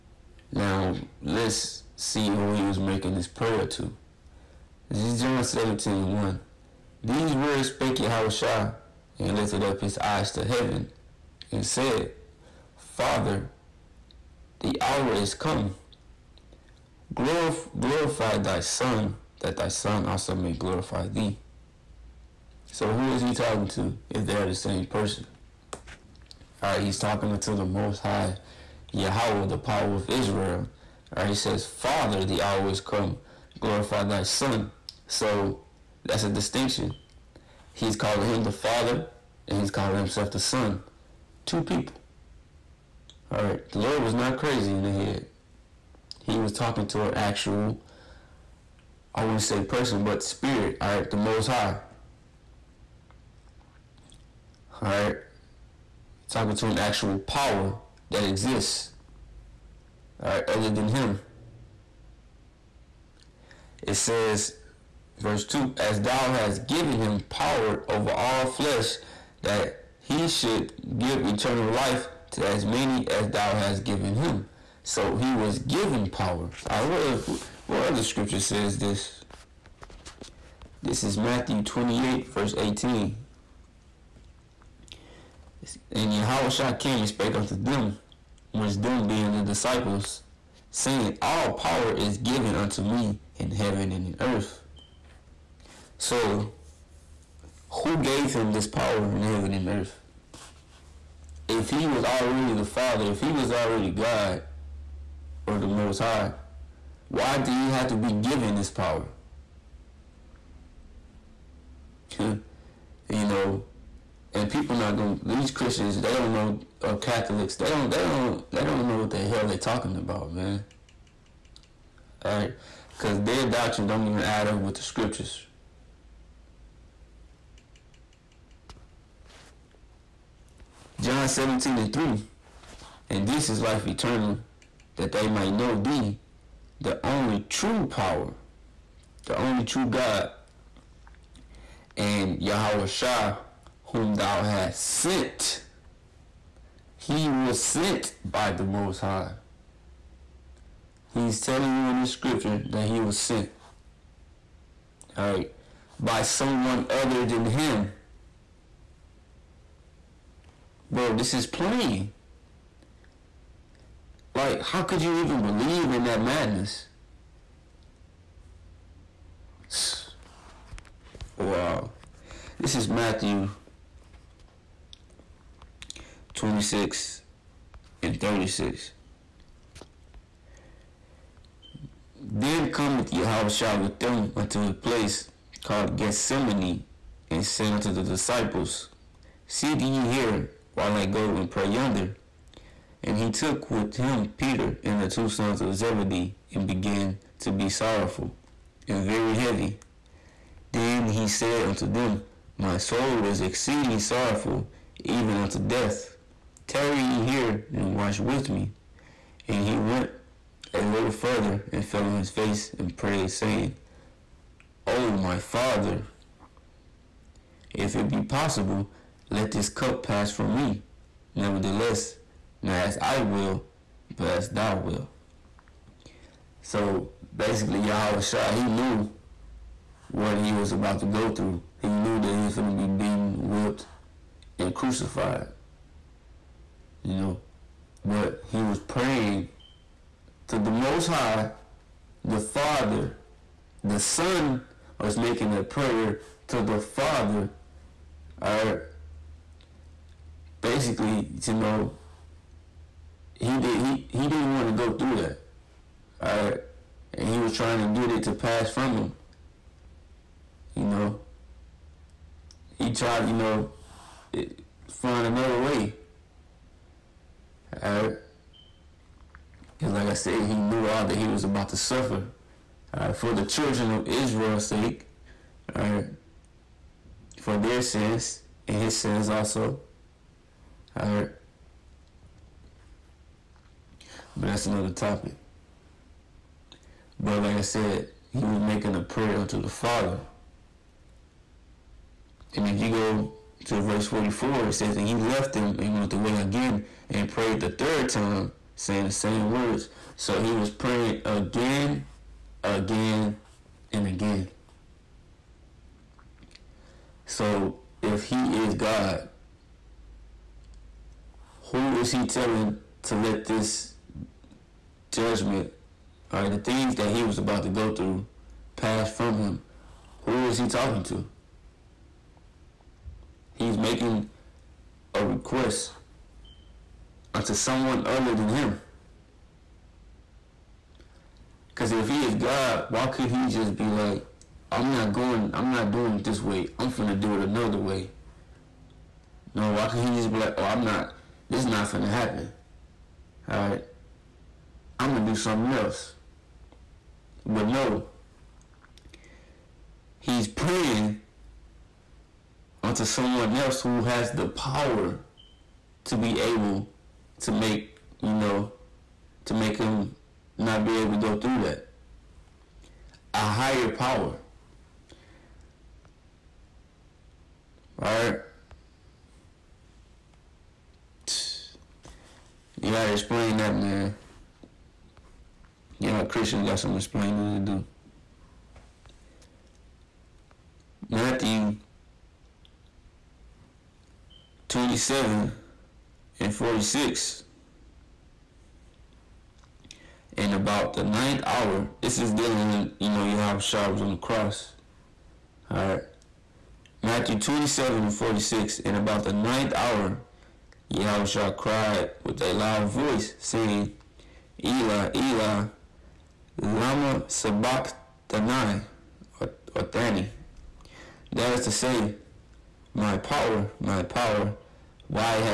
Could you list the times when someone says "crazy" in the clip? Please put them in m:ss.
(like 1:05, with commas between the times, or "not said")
0:44.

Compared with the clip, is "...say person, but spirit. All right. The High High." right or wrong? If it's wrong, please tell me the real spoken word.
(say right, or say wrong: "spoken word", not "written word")
wrong: "Most", not "High".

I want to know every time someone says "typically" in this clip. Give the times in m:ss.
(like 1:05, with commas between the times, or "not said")
not said.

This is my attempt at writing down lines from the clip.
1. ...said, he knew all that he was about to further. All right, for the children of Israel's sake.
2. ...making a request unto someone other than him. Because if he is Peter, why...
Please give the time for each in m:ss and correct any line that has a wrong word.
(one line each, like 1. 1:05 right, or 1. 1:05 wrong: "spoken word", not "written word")
1. 4:30 wrong: "suffer", not "further"
2. 5:23 wrong: "God", not "Peter".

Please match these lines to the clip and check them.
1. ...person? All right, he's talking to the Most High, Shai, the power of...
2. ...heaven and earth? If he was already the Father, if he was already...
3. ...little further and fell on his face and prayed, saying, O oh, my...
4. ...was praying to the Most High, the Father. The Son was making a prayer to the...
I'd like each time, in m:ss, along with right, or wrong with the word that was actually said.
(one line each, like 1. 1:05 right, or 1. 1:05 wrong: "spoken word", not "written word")
1. 0:24 wrong: "Yahweh", not "Shai"
2. 1:39 right
3. 3:30 right
4. 3:58 right.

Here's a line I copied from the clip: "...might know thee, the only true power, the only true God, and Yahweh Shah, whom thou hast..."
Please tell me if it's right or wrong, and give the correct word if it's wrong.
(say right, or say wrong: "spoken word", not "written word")
right.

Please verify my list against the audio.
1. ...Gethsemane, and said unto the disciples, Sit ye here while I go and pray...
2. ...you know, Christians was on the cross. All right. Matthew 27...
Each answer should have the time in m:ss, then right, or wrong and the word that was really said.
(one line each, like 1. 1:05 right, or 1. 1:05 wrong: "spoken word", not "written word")
1. 3:05 right
2. 6:32 wrong: "Yahweh", not "Christians".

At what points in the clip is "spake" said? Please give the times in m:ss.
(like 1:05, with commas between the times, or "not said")
0:07, 1:27.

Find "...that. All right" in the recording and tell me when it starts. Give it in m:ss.
4:15.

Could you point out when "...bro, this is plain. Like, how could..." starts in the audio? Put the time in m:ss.
2:40.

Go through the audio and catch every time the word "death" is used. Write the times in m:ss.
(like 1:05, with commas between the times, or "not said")
3:25.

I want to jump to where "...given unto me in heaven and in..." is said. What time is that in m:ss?
1:32.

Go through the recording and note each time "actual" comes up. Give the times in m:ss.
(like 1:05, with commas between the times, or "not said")
0:47, 0:56.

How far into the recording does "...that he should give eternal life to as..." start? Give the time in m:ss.
1:09.